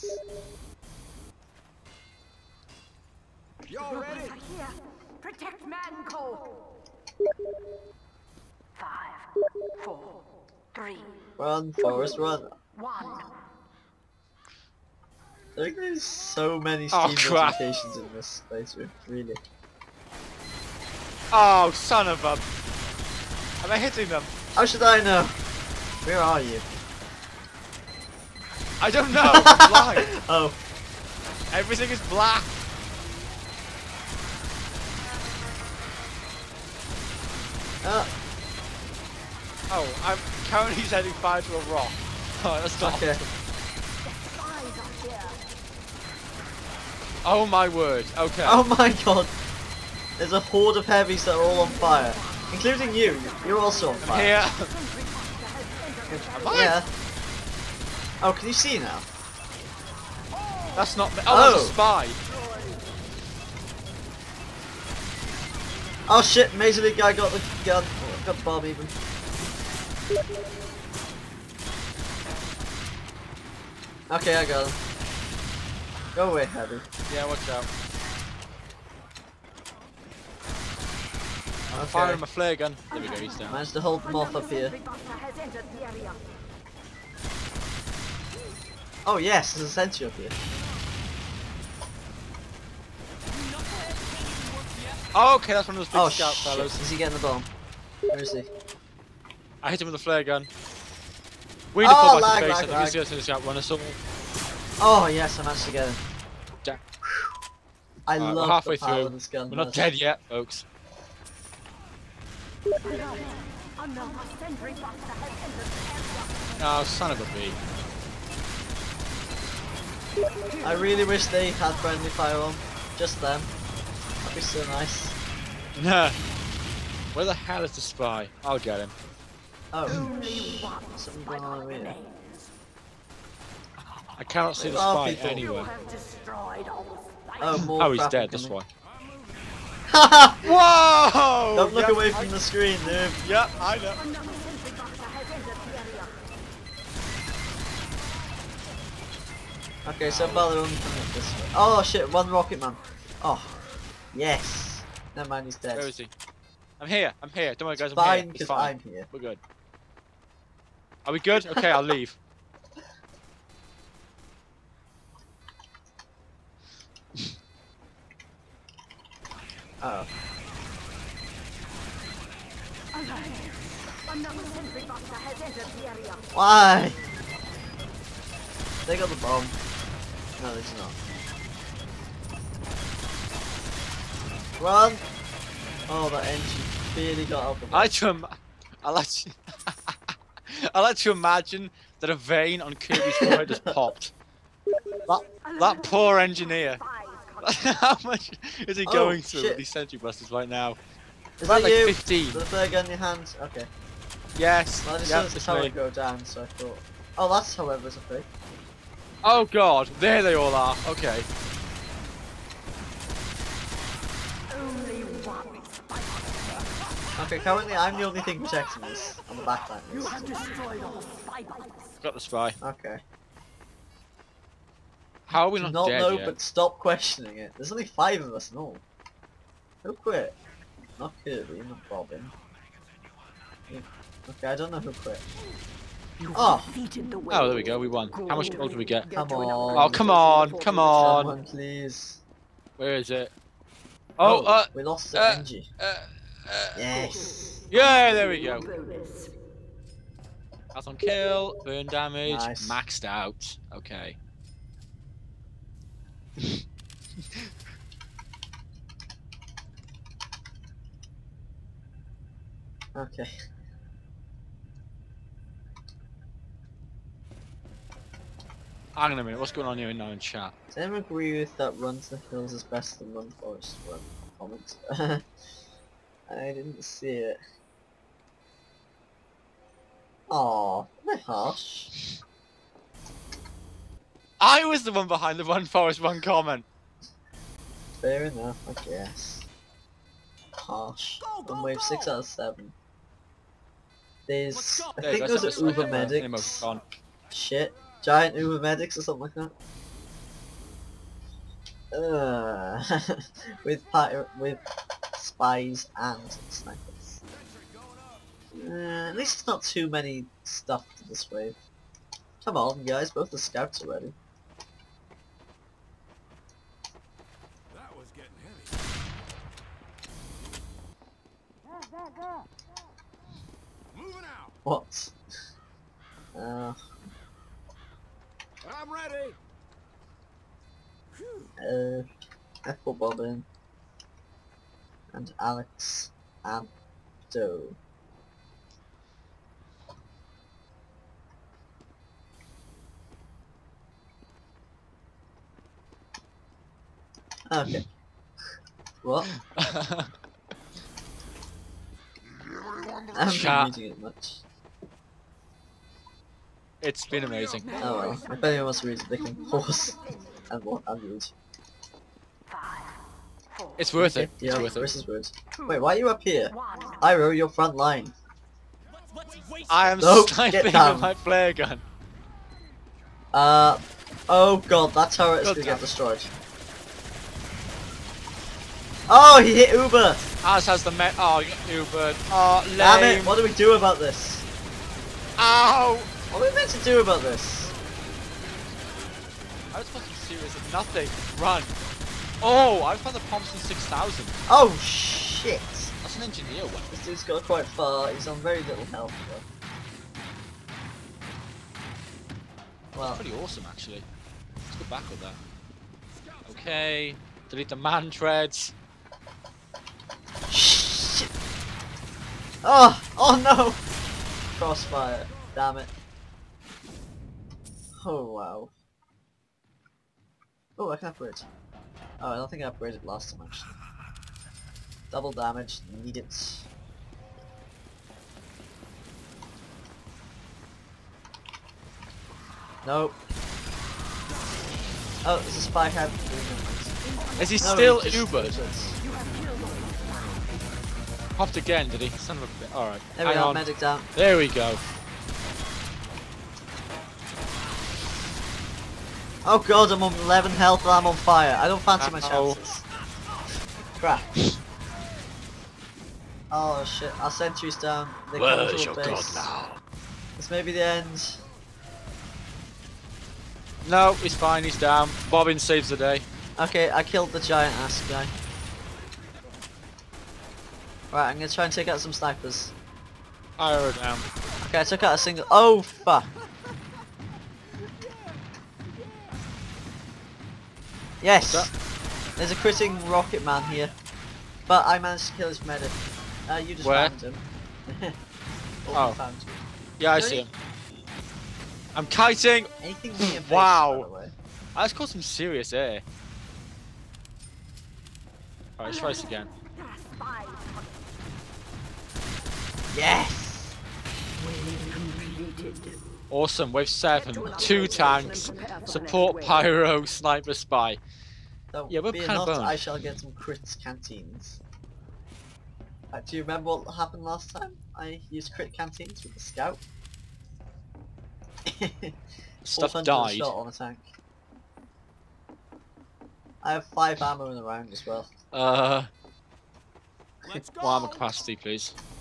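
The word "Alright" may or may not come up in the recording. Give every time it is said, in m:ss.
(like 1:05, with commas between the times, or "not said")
7:22, 8:18.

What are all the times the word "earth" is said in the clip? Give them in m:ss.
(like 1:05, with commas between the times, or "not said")
not said.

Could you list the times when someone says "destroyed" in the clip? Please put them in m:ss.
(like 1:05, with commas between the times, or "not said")
3:40, 6:15.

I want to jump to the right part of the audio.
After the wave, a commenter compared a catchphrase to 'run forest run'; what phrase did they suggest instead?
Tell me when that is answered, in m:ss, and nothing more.
4:31.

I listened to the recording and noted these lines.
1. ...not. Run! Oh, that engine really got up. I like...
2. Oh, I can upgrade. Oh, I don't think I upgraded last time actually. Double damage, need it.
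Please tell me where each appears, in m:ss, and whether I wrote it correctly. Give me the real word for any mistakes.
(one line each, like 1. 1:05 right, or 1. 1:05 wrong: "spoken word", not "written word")
1. 3:00 right
2. 7:00 right.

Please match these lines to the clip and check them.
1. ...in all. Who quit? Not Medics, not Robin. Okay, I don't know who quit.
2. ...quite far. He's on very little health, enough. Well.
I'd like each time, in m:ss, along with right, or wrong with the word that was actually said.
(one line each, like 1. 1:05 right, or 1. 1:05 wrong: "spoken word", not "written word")
1. 3:48 wrong: "Kirby", not "Medics"
2. 6:37 wrong: "though", not "enough".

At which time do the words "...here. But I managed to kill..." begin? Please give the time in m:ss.
8:03.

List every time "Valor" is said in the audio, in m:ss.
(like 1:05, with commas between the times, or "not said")
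2:30.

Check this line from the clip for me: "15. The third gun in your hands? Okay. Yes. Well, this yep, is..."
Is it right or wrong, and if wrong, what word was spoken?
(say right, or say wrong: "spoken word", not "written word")
right.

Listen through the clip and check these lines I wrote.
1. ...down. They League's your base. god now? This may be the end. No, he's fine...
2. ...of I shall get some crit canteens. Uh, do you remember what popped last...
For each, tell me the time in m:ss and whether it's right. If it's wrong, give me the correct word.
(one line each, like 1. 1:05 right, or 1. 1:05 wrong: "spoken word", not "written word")
1. 7:37 wrong: "Where", not "League"
2. 8:32 wrong: "happened", not "popped".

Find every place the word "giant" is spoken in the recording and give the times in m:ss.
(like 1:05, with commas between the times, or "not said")
4:58, 7:47.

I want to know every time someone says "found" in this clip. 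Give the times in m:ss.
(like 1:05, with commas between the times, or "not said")
6:32, 8:09.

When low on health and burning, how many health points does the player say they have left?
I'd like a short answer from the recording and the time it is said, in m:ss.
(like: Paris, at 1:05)
11, at 7:30.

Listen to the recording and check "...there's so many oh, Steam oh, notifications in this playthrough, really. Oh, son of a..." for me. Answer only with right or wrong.
right.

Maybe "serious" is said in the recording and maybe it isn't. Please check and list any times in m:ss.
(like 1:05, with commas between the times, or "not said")
6:30, 8:15.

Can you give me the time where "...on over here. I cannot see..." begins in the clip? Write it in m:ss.
2:11.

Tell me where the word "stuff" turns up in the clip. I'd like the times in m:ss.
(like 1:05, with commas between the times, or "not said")
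5:10, 8:42.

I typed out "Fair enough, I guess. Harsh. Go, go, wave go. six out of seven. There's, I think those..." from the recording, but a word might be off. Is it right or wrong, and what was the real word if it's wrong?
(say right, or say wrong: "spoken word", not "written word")
right.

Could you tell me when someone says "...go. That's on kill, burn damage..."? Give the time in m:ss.
4:08.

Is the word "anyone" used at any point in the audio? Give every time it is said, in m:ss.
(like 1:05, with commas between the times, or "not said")
4:30, 5:58.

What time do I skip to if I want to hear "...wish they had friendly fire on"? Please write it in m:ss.
2:01.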